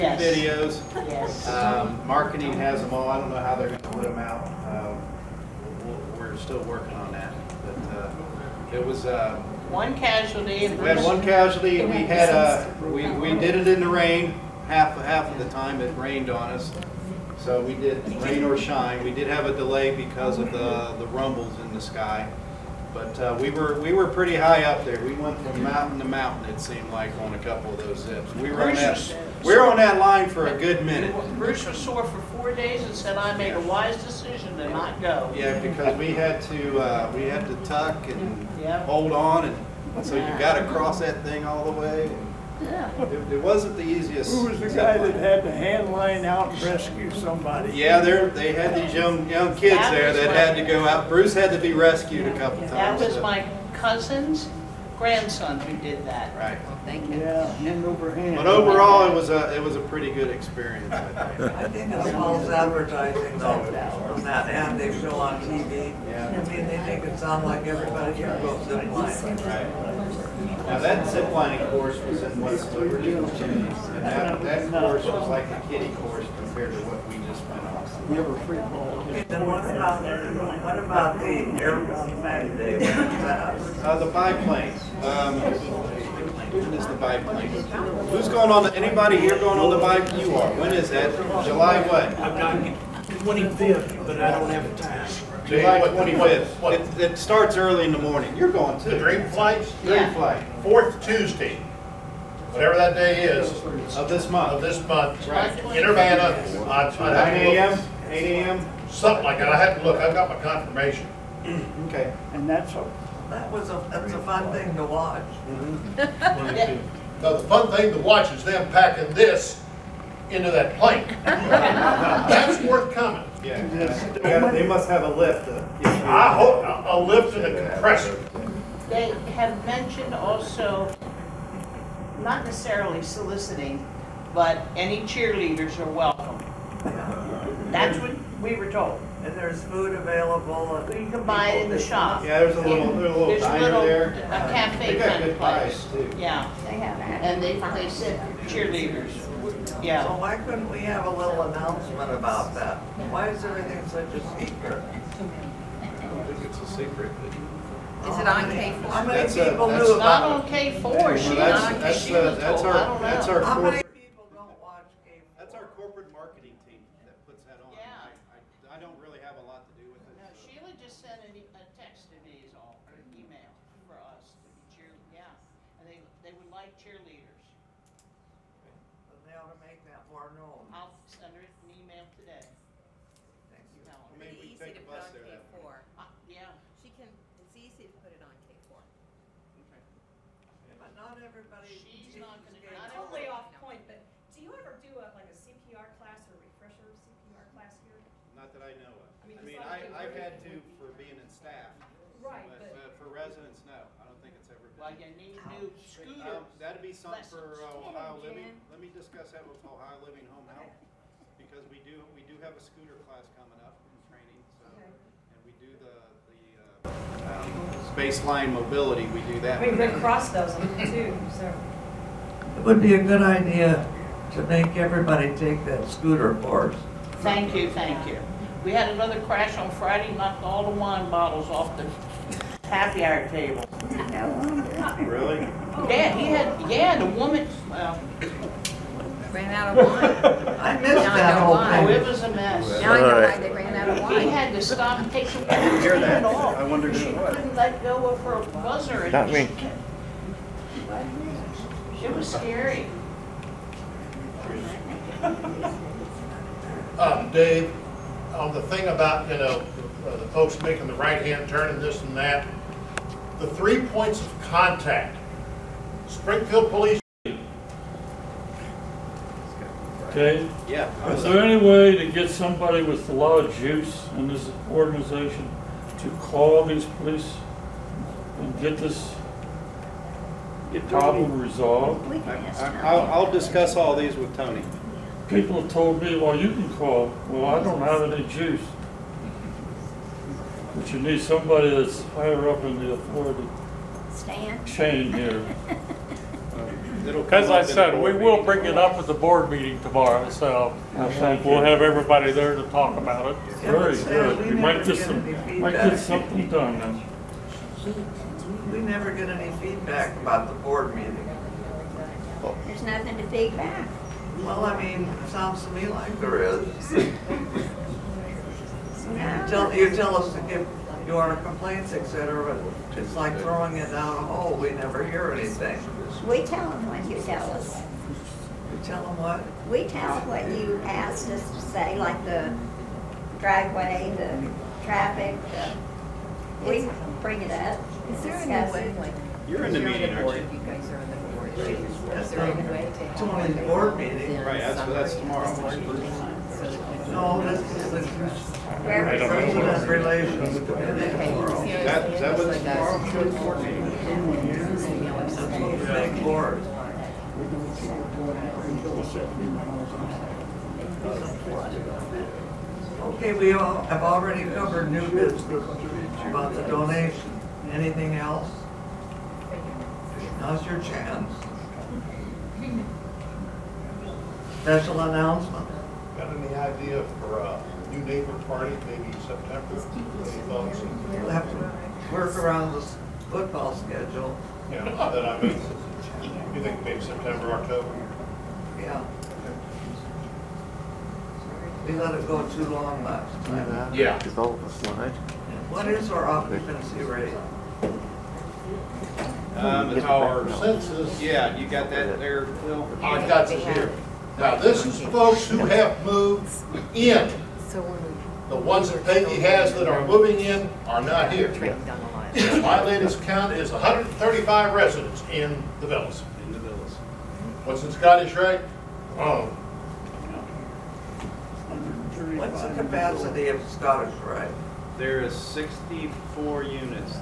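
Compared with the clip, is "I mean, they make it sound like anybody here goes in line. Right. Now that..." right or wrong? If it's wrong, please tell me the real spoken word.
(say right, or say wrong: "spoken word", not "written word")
wrong: "everybody", not "anybody".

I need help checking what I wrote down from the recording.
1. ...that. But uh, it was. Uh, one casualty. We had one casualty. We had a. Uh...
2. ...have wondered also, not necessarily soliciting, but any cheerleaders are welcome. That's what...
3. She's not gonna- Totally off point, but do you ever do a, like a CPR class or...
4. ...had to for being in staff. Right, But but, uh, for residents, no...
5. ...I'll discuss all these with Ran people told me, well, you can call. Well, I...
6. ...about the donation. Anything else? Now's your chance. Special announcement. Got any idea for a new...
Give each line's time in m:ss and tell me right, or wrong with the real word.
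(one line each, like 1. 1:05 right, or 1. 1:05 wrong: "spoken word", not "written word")
1. 0:07 right
2. 2:09 wrong: "mentioned", not "wondered"
3. 3:11 right
4. 3:20 right
5. 4:43 wrong: "Tony", not "Ran"
6. 6:06 right.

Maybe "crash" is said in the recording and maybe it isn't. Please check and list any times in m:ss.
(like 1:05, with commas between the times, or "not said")
3:49.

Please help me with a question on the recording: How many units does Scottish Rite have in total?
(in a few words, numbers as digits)
64.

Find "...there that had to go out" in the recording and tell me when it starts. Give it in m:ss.
0:49.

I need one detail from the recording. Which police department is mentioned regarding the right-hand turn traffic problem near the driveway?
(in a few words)
Springfield Police.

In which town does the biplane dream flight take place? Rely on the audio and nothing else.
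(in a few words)
Urbana.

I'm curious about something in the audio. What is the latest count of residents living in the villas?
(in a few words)
135.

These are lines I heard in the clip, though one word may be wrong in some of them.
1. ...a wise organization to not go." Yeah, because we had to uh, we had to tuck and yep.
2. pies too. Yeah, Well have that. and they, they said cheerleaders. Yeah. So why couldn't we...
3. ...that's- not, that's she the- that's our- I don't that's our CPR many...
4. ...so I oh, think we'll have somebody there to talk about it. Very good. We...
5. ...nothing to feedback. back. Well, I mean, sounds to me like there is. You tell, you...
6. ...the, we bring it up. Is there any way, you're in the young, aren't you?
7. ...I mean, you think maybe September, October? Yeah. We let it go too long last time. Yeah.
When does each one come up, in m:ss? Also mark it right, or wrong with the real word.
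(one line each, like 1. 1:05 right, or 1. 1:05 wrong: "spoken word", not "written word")
1. 0:33 wrong: "decision", not "organization"
2. 2:25 wrong: "They", not "Well"
3. 2:41 wrong: "How", not "CPR"
4. 5:00 wrong: "everybody", not "somebody"
5. 5:12 right
6. 5:35 wrong: "meeting", not "young"
7. 6:25 right.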